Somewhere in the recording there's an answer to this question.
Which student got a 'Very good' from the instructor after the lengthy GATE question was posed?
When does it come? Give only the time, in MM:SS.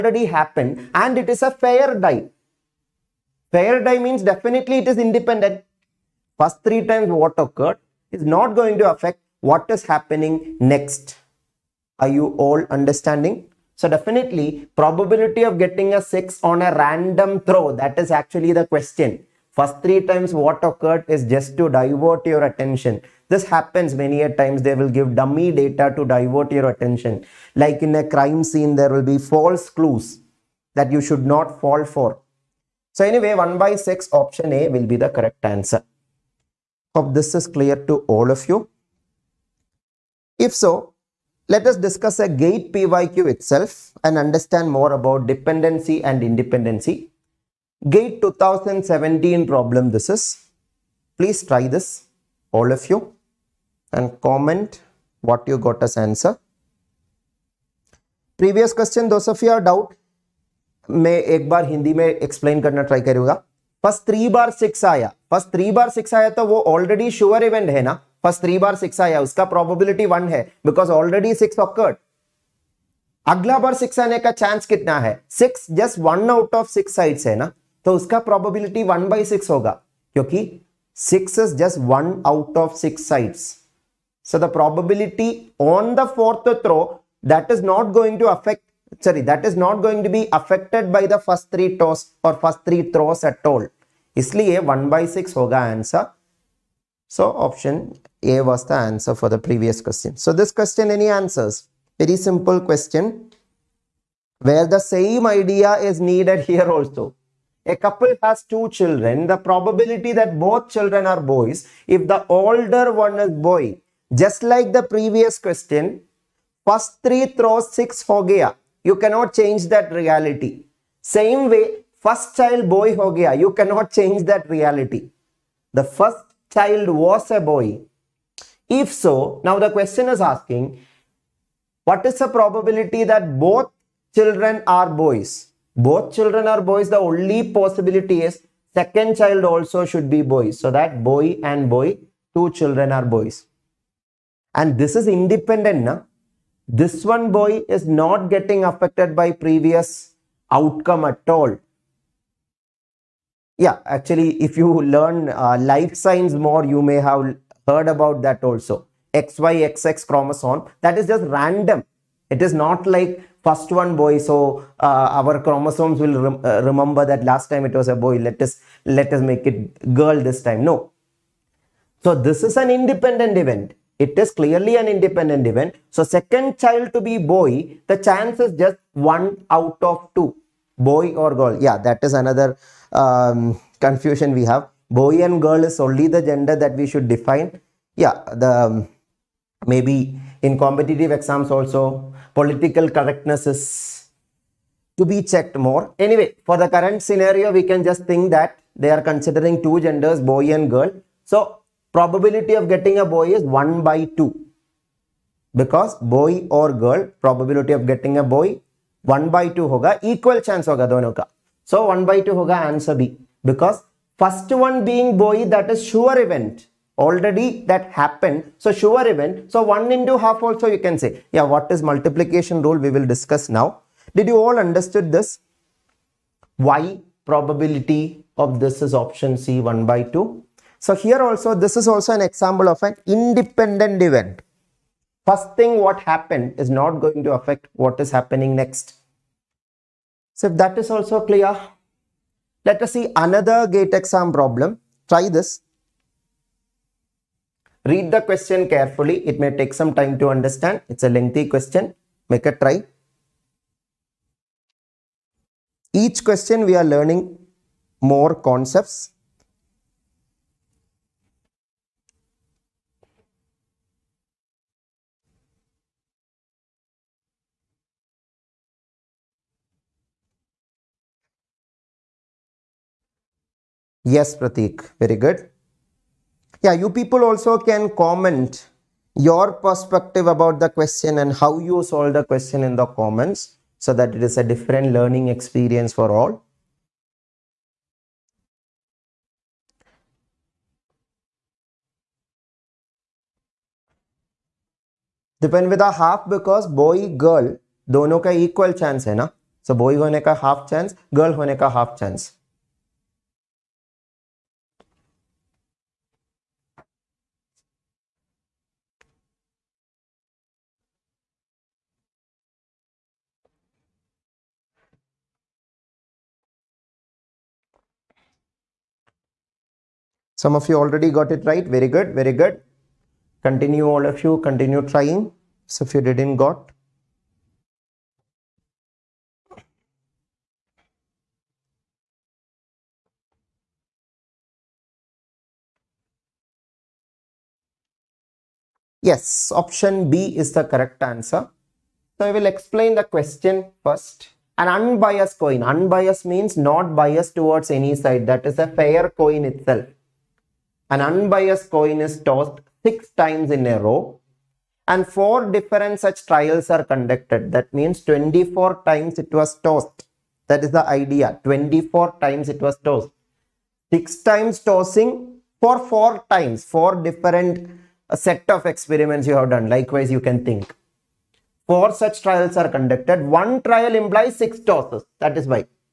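04:34.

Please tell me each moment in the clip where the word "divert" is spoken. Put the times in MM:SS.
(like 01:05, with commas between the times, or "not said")
00:21, 00:26.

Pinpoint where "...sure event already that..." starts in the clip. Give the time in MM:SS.
03:35.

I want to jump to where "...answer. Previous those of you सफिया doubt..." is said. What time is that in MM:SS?
00:55.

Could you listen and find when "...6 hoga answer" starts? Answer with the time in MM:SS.
01:35.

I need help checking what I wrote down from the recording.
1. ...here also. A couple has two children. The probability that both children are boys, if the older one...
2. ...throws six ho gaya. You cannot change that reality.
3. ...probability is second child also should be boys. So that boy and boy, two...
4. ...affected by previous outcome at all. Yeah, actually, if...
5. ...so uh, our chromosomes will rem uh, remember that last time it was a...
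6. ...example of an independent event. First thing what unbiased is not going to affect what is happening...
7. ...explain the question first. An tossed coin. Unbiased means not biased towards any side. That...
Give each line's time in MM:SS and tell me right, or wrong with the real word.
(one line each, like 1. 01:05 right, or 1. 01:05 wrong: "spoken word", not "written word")
1. 01:46 right
2. 01:57 right
3. 02:17 wrong: "possibility", not "probability"
4. 02:28 right
5. 02:44 right
6. 03:52 wrong: "happened", not "unbiased"
7. 05:42 wrong: "unbiased", not "tossed".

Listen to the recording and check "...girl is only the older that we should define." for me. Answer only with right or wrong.
wrong.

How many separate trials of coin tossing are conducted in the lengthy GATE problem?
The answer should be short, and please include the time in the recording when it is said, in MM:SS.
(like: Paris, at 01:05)
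4, at 05:55.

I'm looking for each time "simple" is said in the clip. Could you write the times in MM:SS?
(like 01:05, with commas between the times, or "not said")
01:42.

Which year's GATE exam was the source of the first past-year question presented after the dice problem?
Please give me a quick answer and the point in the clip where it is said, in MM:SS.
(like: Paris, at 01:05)
2017, at 00:47.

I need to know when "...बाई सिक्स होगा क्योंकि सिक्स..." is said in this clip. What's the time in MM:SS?
01:19.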